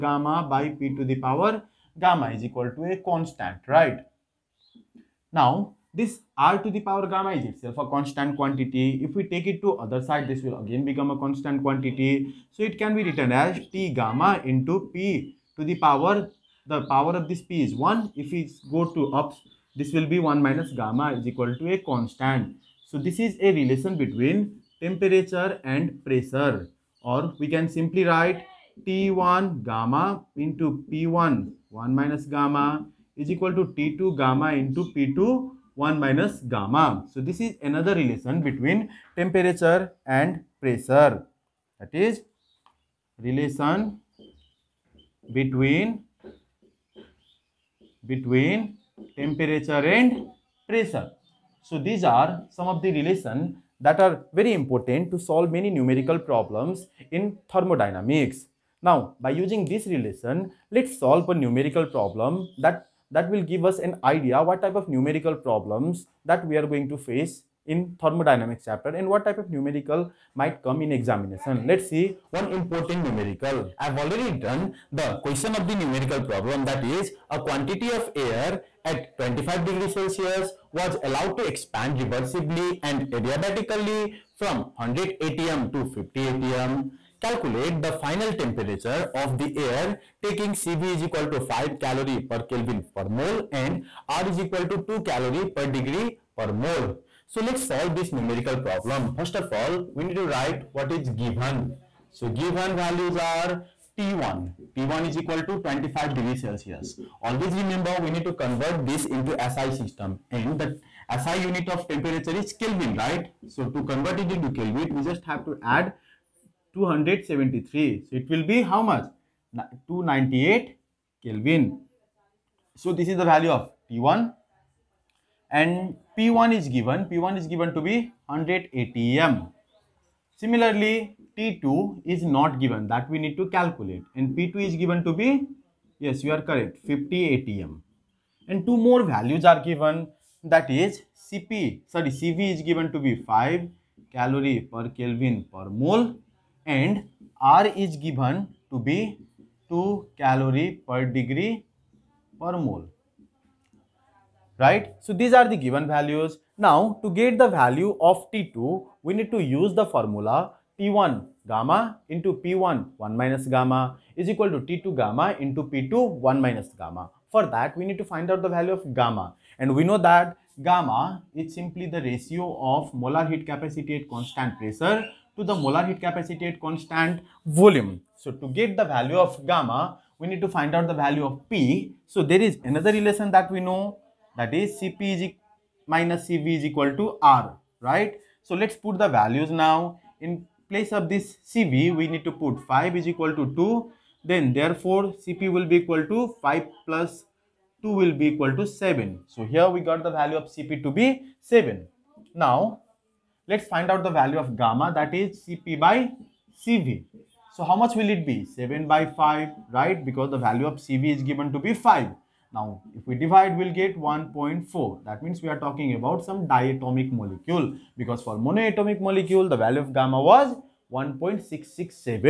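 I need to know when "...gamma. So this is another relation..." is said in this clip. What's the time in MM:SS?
00:36.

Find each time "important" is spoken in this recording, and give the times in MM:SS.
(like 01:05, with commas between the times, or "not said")
00:54, 01:12.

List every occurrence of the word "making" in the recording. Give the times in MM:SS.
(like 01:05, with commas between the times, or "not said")
not said.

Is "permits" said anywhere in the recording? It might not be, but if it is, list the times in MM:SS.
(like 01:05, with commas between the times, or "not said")
not said.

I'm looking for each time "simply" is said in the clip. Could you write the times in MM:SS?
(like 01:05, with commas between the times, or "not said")
00:27, 02:51.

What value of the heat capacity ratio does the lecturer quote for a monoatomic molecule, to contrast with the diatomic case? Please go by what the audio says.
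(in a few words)
1.667.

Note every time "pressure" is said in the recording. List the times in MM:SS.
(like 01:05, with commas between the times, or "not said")
00:26, 00:40, 00:50, 02:54.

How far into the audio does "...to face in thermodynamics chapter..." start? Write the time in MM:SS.
01:06.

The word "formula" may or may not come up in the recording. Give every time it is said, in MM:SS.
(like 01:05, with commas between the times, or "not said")
02:39.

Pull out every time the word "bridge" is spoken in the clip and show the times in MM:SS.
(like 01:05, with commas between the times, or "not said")
not said.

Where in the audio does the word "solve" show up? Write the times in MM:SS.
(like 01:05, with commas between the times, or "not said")
00:55, 01:00, 01:37.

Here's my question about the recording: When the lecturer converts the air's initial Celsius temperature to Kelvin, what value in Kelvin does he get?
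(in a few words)
298 Kelvin.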